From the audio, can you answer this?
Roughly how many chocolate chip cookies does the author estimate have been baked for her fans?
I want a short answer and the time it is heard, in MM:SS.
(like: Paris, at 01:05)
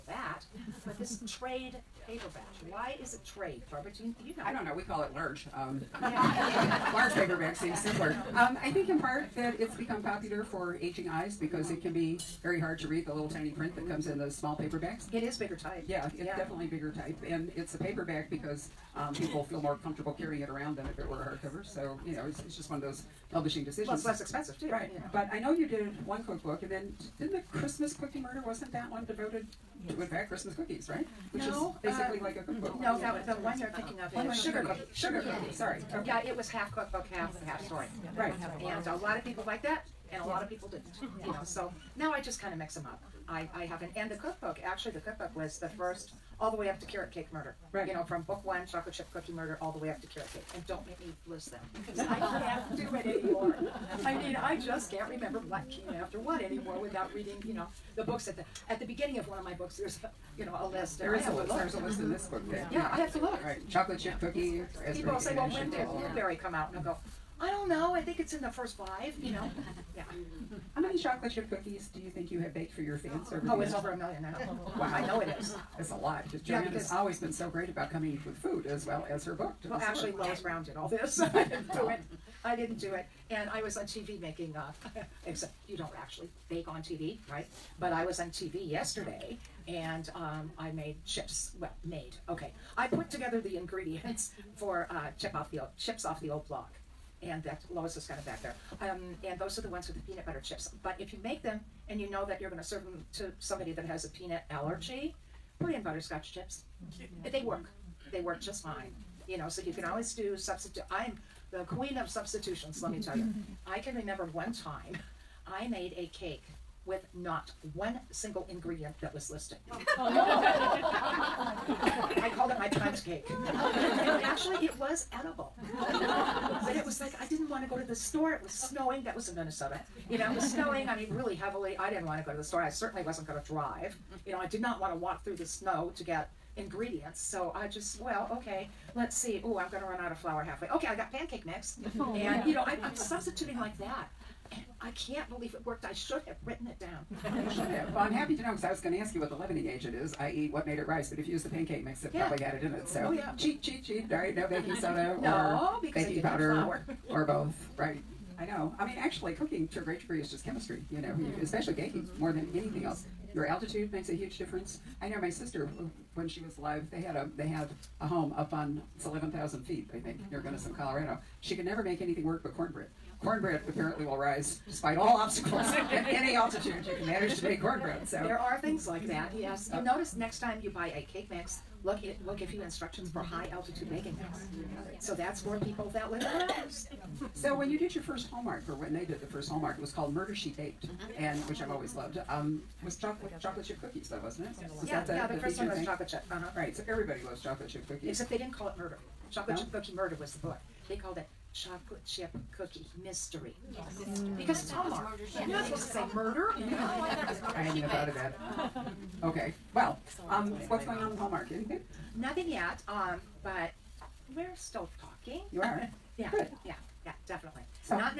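Over 1 million, at 01:13.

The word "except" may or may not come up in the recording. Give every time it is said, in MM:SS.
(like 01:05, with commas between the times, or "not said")
01:25, 03:18.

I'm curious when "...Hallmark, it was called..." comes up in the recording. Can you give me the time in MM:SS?
03:09.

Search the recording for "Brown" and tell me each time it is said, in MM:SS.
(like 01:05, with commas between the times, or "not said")
01:20.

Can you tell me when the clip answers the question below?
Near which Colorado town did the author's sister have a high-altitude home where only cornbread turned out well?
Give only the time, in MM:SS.
02:50.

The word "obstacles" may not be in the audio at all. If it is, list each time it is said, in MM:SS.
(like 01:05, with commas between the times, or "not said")
02:55.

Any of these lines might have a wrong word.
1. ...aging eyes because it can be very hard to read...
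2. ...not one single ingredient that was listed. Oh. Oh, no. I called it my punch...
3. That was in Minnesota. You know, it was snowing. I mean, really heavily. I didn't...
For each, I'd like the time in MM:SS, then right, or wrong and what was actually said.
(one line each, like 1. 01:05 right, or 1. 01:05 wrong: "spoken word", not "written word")
1. 00:10 right
2. 01:57 right
3. 02:09 right.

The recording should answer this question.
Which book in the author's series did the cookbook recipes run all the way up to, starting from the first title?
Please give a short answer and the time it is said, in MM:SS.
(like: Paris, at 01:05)
Carrot Cake Murder, at 00:46.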